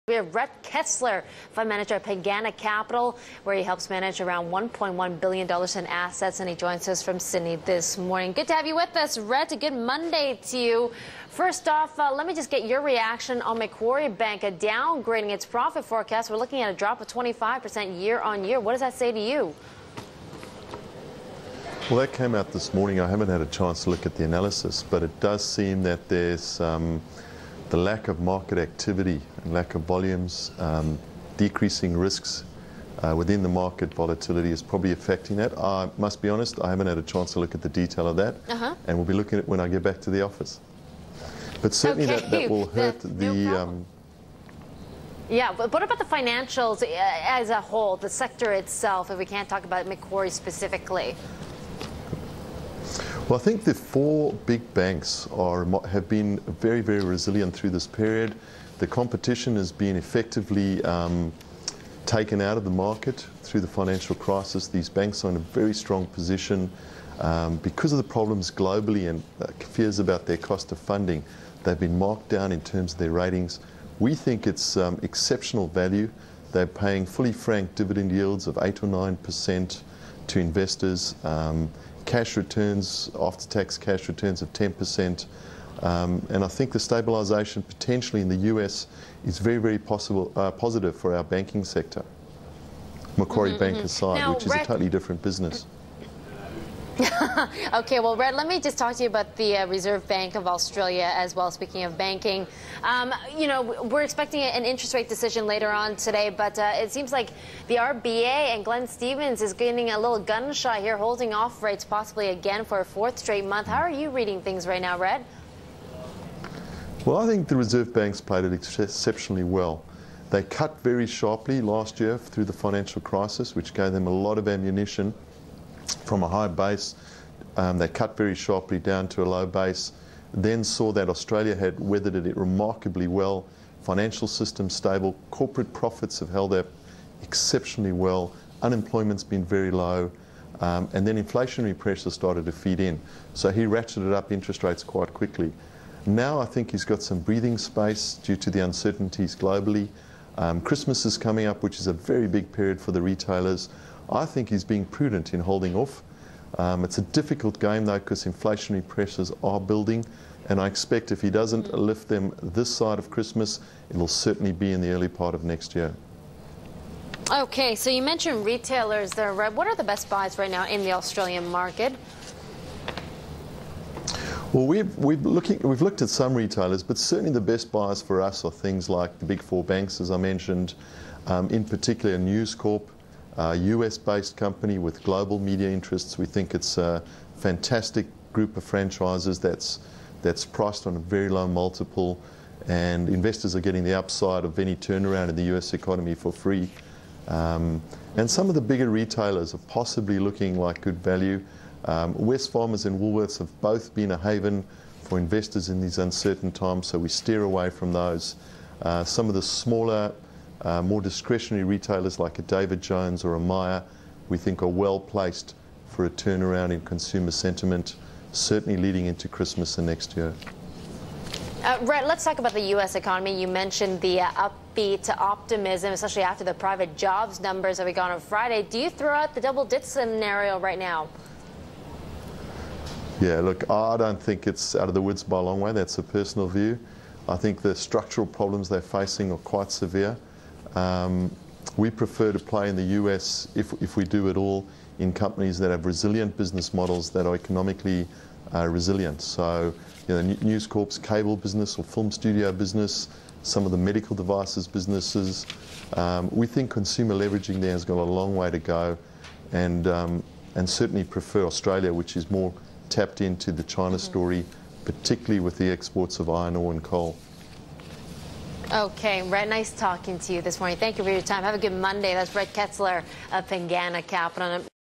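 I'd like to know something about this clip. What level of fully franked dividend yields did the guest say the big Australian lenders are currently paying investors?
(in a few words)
8 or 9%.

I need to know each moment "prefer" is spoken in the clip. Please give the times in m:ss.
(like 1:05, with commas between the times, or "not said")
4:01, 4:21.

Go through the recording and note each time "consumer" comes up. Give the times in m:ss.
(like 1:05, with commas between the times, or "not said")
3:36, 4:16.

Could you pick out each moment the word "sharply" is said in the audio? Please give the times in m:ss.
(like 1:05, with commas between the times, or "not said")
2:01, 2:08.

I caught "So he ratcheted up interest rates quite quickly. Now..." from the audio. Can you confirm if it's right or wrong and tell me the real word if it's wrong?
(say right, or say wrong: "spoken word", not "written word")
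right.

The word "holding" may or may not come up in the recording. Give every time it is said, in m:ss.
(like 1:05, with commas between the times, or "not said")
1:50, 2:35.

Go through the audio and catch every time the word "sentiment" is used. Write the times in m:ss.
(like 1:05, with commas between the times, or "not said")
3:37.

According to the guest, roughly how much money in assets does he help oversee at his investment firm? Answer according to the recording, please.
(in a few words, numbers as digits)
$1.1 billion.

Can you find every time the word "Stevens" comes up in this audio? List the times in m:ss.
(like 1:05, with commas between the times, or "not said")
1:48.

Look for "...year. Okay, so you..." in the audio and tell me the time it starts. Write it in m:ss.
2:45.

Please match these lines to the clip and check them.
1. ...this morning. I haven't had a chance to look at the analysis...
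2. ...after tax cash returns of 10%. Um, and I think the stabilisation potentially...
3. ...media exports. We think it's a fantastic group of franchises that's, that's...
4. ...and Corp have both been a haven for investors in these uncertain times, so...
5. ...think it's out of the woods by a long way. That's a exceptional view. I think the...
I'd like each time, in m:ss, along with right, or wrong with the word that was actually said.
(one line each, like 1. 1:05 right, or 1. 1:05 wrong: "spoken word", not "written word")
1. 0:22 right
2. 1:23 right
3. 3:05 wrong: "interests", not "exports"
4. 3:22 wrong: "Woolworths", not "Corp"
5. 3:54 wrong: "personal", not "exceptional".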